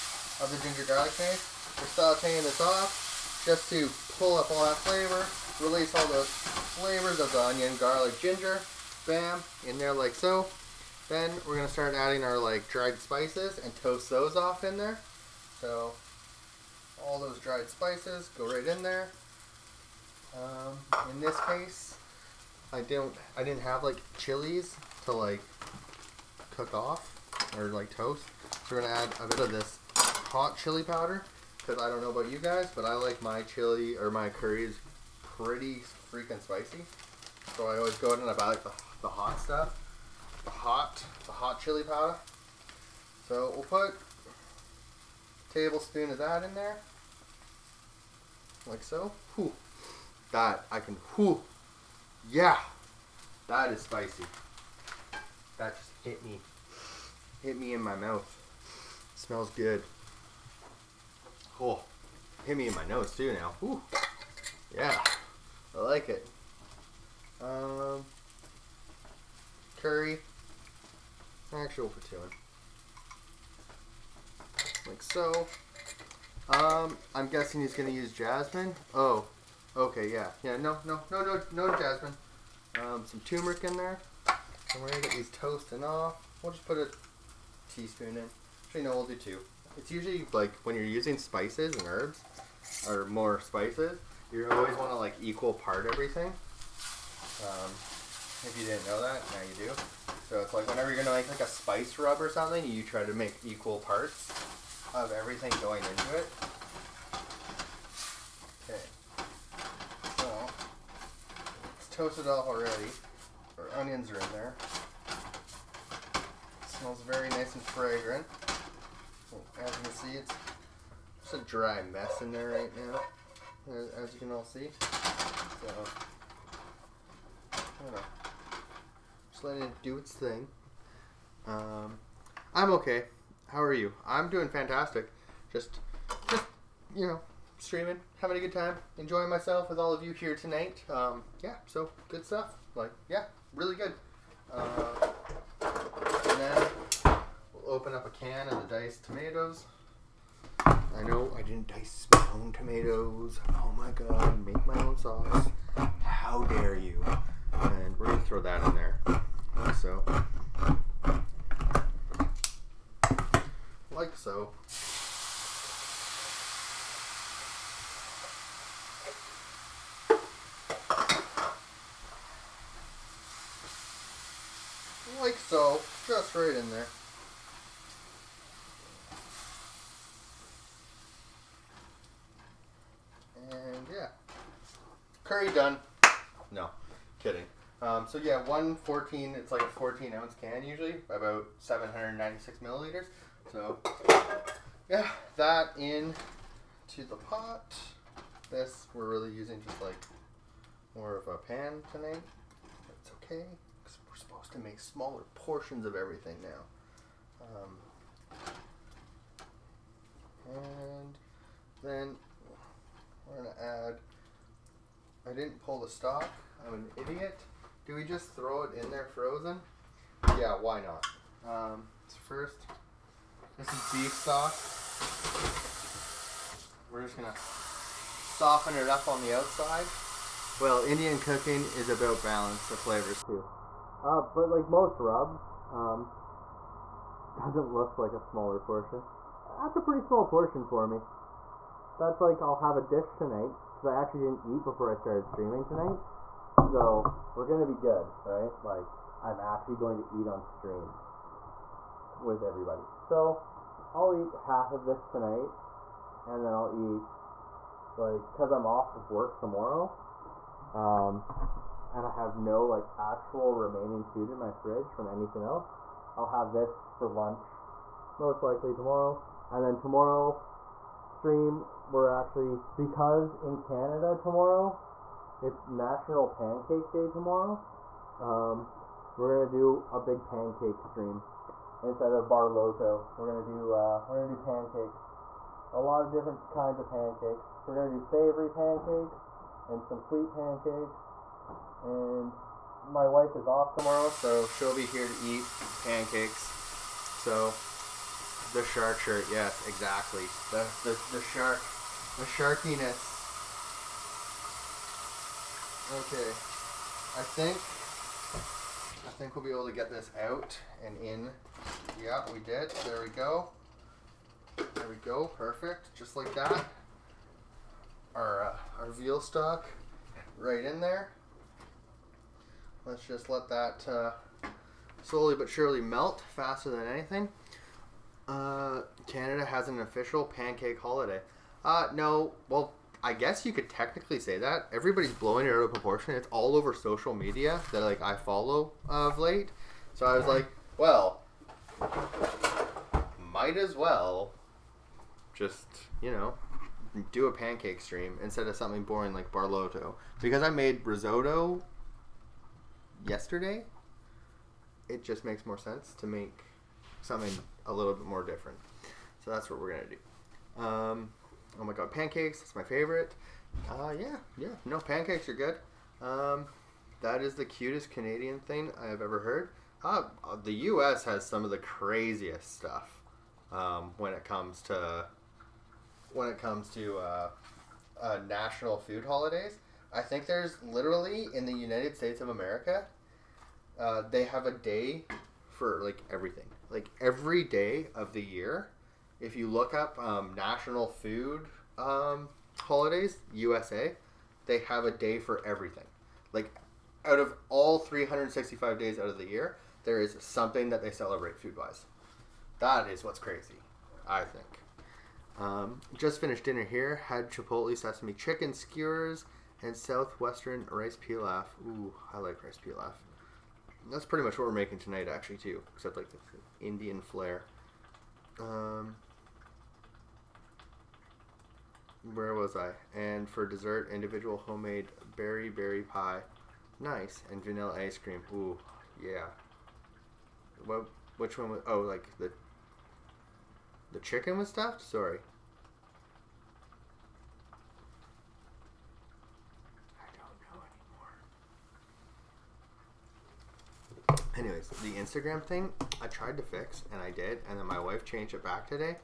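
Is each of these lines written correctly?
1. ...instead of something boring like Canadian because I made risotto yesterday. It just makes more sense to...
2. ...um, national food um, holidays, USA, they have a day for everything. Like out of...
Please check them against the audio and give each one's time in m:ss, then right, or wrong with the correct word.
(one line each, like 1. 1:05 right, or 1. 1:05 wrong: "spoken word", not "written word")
1. 5:48 wrong: "Barlotto", not "Canadian"
2. 6:29 right.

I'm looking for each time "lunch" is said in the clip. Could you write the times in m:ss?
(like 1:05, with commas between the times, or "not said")
4:27.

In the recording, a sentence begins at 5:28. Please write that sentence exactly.
Uh, Canada has an official pancake holiday.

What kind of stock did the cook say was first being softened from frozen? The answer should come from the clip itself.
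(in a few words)
beef stock.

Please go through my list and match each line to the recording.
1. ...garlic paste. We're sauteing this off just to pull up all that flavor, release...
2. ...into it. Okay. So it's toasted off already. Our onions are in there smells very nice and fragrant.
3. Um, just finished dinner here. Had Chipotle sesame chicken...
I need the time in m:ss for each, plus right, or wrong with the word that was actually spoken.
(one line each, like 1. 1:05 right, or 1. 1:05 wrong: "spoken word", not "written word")
1. 0:00 right
2. 1:45 right
3. 6:45 right.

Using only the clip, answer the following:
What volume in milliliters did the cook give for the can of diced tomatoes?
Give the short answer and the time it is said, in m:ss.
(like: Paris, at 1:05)
796, at 3:11.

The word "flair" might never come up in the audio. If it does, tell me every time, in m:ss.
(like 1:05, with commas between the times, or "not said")
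6:57.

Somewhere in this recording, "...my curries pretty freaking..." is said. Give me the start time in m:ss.
0:34.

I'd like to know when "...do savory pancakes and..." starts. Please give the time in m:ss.
4:47.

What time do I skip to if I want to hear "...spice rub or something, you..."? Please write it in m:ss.
1:41.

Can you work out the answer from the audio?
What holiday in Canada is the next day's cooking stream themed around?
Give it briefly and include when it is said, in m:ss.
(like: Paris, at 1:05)
National Pancake Day, at 4:35.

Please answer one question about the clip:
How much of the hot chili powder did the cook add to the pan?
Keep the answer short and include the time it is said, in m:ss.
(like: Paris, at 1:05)
a tablespoon, at 0:43.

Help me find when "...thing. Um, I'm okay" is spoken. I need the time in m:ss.
2:10.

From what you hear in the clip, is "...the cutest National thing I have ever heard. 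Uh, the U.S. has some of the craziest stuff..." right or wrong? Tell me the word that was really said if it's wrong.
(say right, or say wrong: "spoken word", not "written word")
wrong: "Canadian", not "National".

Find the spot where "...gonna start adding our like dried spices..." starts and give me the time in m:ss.
0:11.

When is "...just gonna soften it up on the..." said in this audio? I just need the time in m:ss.
3:47.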